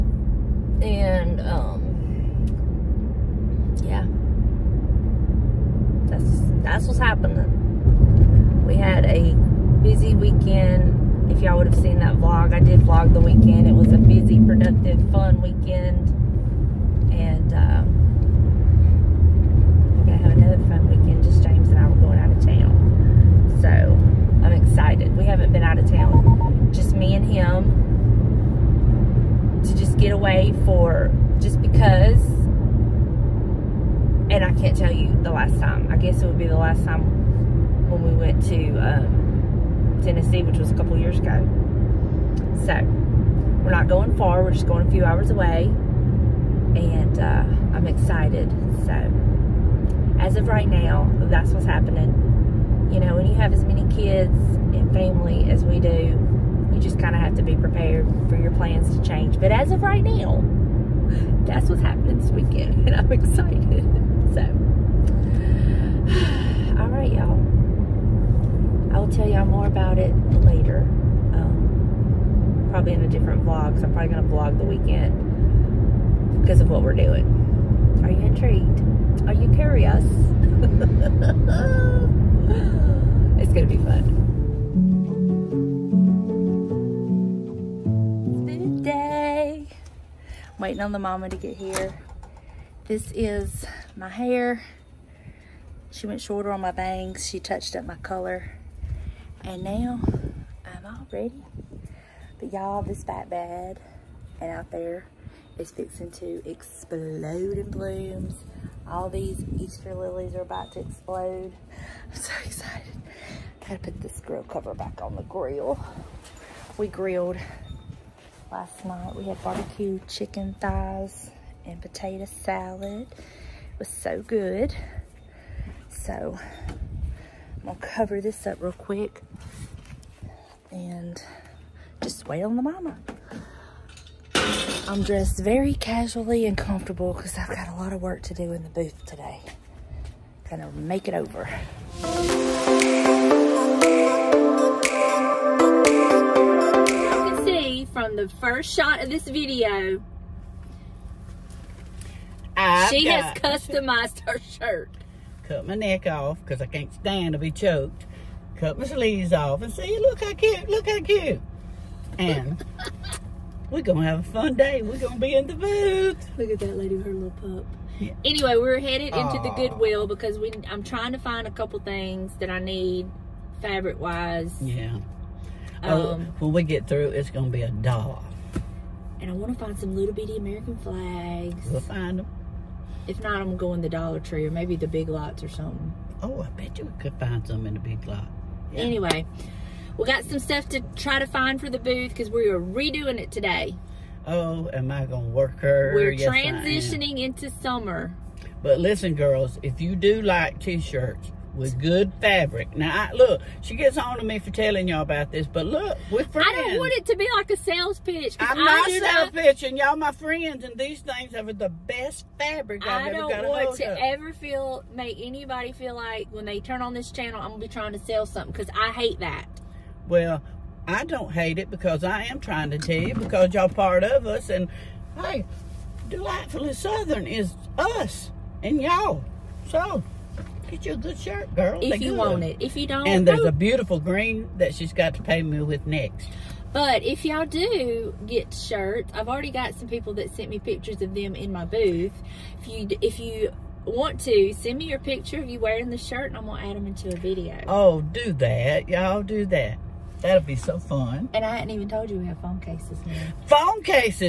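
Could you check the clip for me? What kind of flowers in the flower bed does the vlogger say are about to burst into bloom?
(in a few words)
Easter lilies.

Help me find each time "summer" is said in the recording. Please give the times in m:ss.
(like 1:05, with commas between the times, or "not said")
3:17.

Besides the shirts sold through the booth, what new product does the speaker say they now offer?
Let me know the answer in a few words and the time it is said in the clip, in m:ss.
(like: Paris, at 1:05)
Phone cases, at 4:12.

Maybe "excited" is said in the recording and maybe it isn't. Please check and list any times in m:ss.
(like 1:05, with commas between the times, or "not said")
0:47, 1:03, 1:52.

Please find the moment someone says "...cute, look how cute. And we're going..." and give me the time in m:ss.
2:40.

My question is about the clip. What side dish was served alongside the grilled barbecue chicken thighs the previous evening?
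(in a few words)
Potato salad.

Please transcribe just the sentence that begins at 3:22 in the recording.
Now, I, look, she gets on to me for telling y'all about this, but look, we're friends.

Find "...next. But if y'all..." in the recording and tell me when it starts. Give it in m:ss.
3:55.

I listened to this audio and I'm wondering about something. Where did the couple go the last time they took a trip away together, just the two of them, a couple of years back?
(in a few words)
Tennessee.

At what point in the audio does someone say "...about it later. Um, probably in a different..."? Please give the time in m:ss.
1:09.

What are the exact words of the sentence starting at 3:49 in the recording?
So, Get you a good shirt, girl.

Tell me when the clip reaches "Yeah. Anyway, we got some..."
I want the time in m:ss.
3:08.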